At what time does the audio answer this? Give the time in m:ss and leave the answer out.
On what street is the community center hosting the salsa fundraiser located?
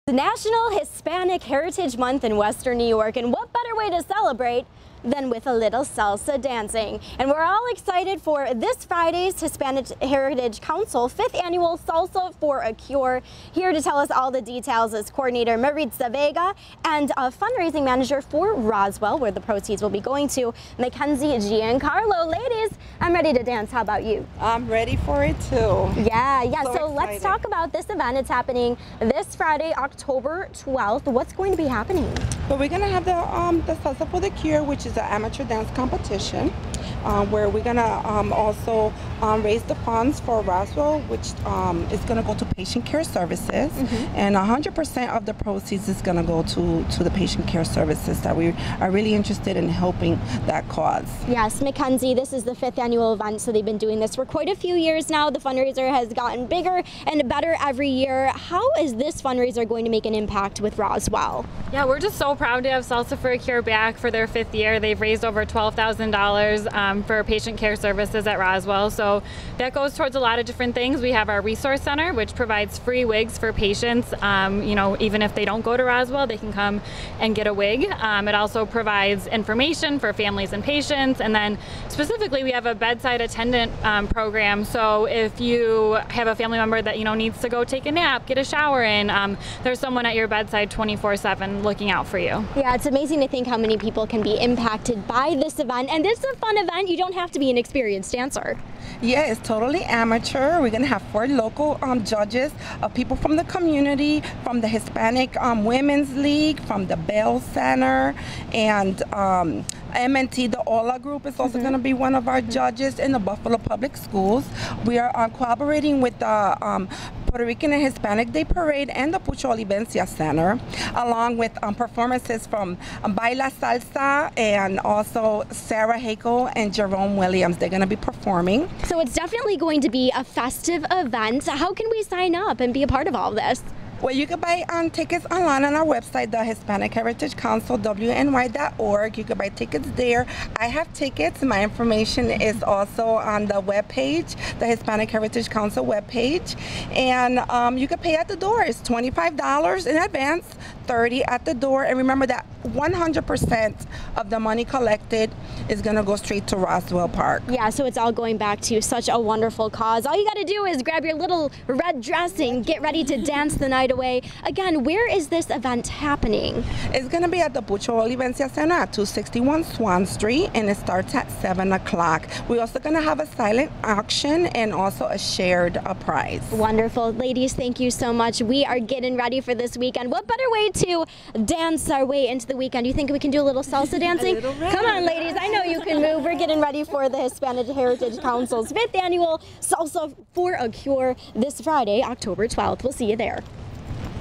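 2:49.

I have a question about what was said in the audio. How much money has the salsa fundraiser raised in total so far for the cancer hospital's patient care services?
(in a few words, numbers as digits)
over $12,000.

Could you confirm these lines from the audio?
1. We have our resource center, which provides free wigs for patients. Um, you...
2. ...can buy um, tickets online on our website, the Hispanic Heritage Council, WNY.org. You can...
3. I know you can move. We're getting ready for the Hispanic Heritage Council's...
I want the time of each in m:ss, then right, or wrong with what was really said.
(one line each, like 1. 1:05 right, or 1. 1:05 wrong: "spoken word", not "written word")
1. 1:11 right
2. 2:14 right
3. 3:05 right.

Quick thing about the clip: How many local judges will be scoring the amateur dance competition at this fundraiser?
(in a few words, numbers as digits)
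4.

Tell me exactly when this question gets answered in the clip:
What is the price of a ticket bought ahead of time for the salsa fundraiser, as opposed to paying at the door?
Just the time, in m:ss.
2:28.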